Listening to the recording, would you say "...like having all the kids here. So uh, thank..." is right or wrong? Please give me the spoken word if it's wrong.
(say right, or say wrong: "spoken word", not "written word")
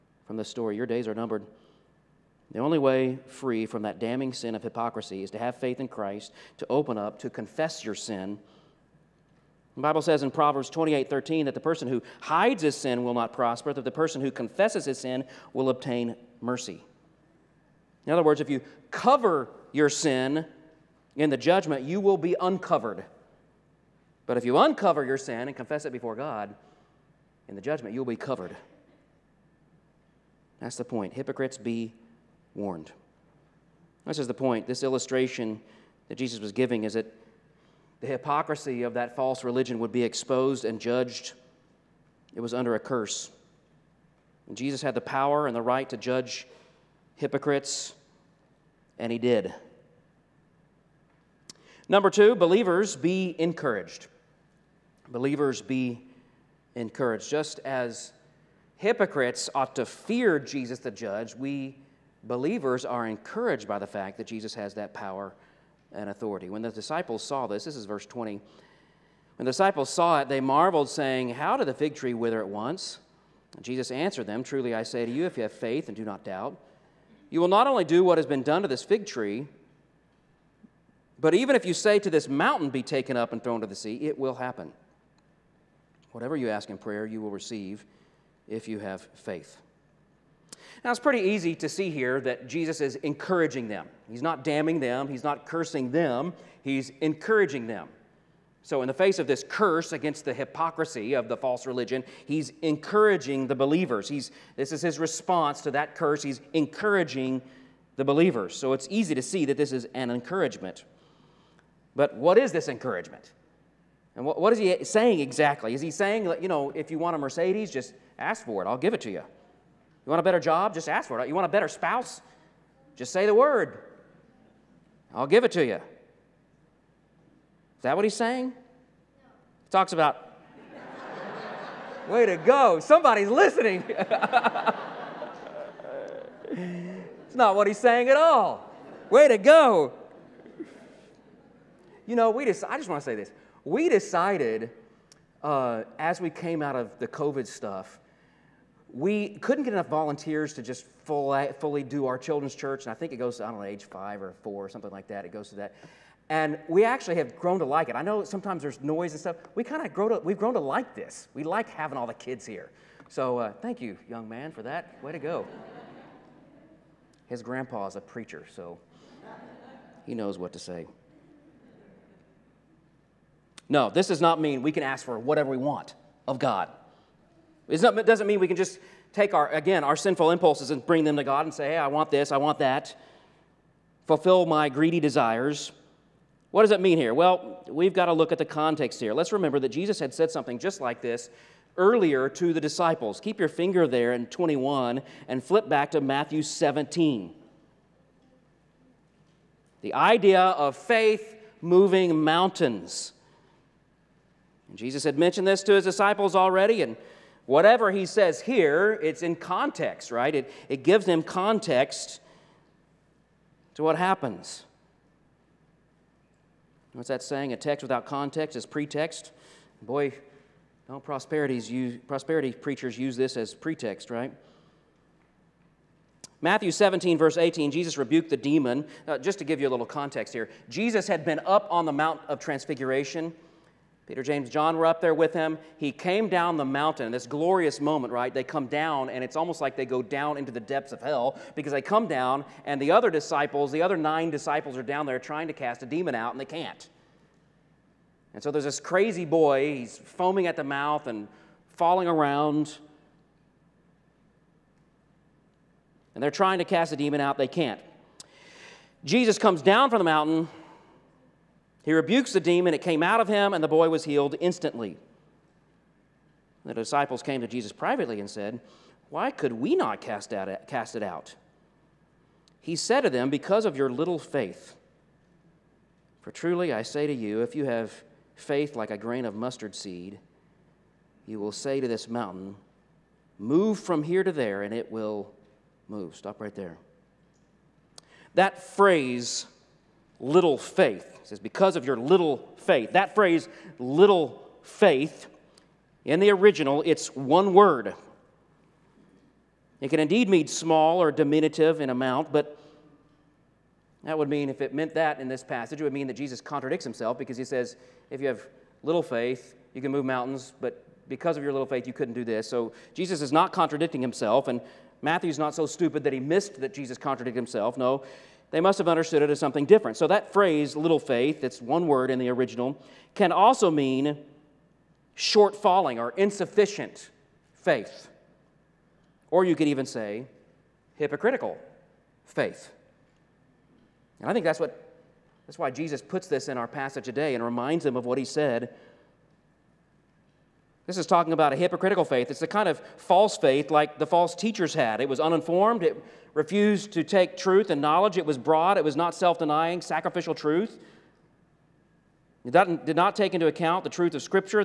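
right.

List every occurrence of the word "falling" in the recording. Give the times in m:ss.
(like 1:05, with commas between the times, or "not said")
4:11, 5:25.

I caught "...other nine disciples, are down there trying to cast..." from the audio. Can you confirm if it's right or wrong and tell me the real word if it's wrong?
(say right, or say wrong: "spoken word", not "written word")
right.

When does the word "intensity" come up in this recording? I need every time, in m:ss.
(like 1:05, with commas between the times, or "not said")
not said.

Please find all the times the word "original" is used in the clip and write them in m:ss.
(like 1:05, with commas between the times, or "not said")
4:56, 5:22.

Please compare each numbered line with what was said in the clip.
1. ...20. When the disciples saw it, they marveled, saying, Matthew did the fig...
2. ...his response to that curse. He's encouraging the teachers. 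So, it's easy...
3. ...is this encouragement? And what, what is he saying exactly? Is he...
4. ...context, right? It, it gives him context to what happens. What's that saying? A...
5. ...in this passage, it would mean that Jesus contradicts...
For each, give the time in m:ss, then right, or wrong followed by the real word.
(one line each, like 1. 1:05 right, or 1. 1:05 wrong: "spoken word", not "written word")
1. 1:08 wrong: "How", not "Matthew"
2. 1:44 wrong: "believers", not "teachers"
3. 1:52 right
4. 3:29 right
5. 5:05 right.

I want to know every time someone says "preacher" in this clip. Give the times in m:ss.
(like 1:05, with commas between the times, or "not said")
2:48, 3:42.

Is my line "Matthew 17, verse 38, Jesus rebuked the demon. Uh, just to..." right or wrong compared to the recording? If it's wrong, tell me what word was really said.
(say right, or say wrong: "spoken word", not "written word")
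wrong: "18", not "38".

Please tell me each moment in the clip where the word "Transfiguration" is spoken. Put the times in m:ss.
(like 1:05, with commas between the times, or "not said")
3:52.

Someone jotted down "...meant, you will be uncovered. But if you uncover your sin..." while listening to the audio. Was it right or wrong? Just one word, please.
wrong.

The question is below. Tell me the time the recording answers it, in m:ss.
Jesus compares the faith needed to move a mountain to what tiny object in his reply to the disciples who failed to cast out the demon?
4:38.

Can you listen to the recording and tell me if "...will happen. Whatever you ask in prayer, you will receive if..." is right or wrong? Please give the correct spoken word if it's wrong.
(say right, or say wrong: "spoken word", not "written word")
right.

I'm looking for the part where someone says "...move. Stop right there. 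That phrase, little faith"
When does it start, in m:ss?
4:45.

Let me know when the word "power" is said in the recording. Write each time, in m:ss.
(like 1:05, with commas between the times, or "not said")
0:45, 1:04.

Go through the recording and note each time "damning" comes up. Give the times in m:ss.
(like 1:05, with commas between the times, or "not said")
0:04, 1:34.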